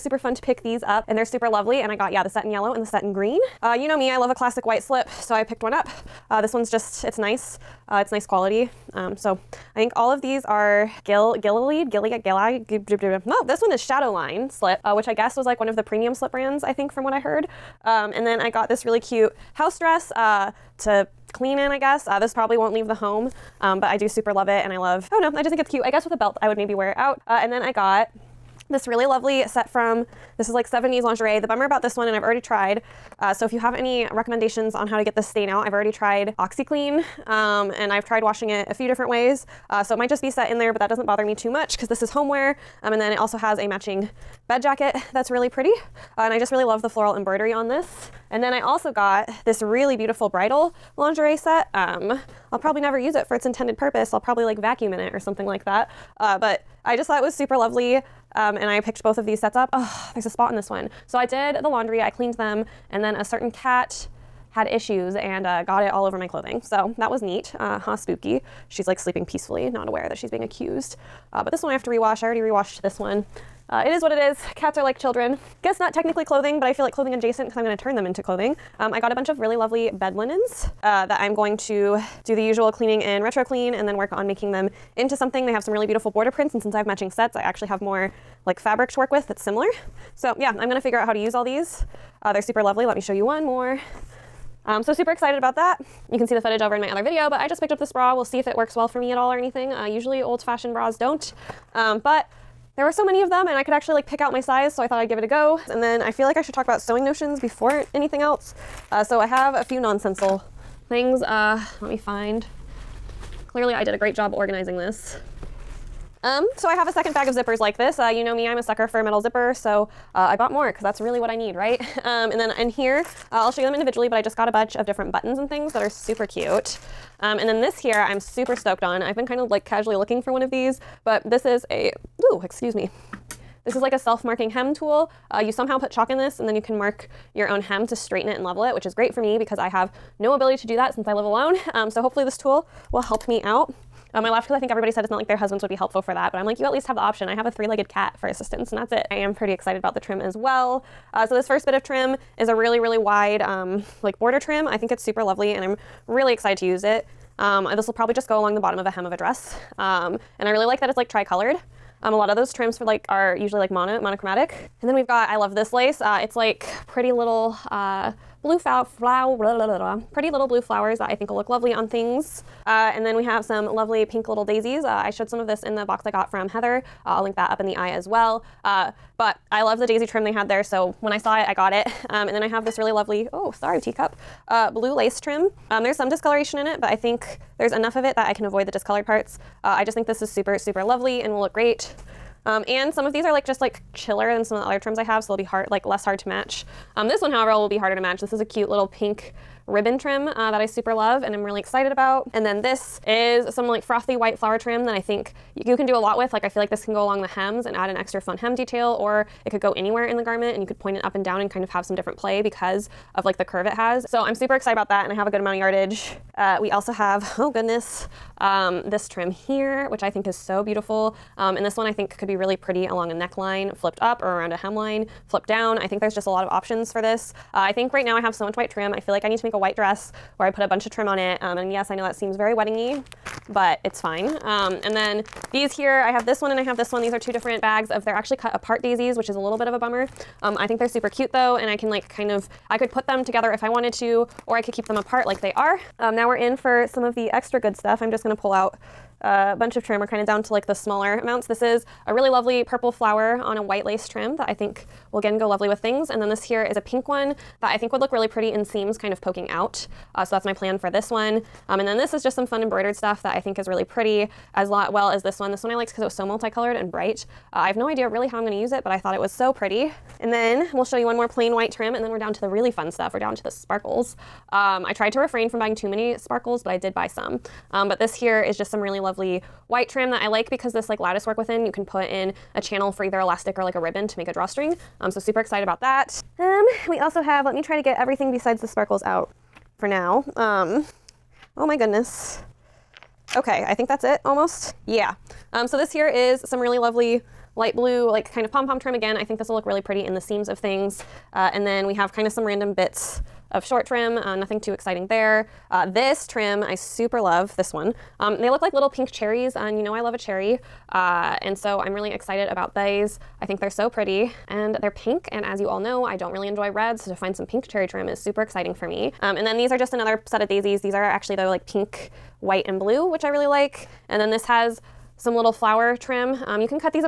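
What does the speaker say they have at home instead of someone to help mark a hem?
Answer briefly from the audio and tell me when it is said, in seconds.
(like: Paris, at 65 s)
a three-legged cat, at 147 s.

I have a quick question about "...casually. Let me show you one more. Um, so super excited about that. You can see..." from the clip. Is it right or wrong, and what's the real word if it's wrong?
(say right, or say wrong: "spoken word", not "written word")
wrong: "lovely", not "casually".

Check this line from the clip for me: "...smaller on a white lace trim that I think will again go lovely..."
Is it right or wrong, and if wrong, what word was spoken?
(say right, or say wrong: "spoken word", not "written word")
wrong: "flower", not "smaller".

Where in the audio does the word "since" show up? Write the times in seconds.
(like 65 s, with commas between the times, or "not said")
86 s, 140 s.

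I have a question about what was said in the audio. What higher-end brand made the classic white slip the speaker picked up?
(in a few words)
Shadowline.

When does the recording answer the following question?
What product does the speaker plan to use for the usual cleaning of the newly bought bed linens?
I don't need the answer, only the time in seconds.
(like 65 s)
83 s.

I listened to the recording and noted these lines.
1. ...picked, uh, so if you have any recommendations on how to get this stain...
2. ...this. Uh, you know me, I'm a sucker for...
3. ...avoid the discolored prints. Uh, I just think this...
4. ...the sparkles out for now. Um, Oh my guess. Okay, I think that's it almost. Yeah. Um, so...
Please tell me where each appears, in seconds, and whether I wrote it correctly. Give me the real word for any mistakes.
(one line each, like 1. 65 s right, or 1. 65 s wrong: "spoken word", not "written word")
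1. 32 s wrong: "tried", not "picked"
2. 117 s right
3. 188 s wrong: "parts", not "prints"
4. 288 s wrong: "goodness", not "guess".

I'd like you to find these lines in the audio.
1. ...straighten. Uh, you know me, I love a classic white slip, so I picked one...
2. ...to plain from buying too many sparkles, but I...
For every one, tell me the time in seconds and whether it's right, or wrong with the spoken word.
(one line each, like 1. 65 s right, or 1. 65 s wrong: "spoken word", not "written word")
1. 3 s wrong: "green", not "straighten"
2. 275 s wrong: "refrain", not "plain".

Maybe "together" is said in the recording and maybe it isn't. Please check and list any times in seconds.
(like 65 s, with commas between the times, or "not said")
243 s.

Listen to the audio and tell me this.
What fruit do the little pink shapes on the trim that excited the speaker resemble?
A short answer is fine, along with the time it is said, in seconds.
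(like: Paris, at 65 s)
cherries, at 309 s.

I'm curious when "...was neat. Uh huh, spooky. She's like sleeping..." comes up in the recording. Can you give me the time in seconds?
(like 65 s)
67 s.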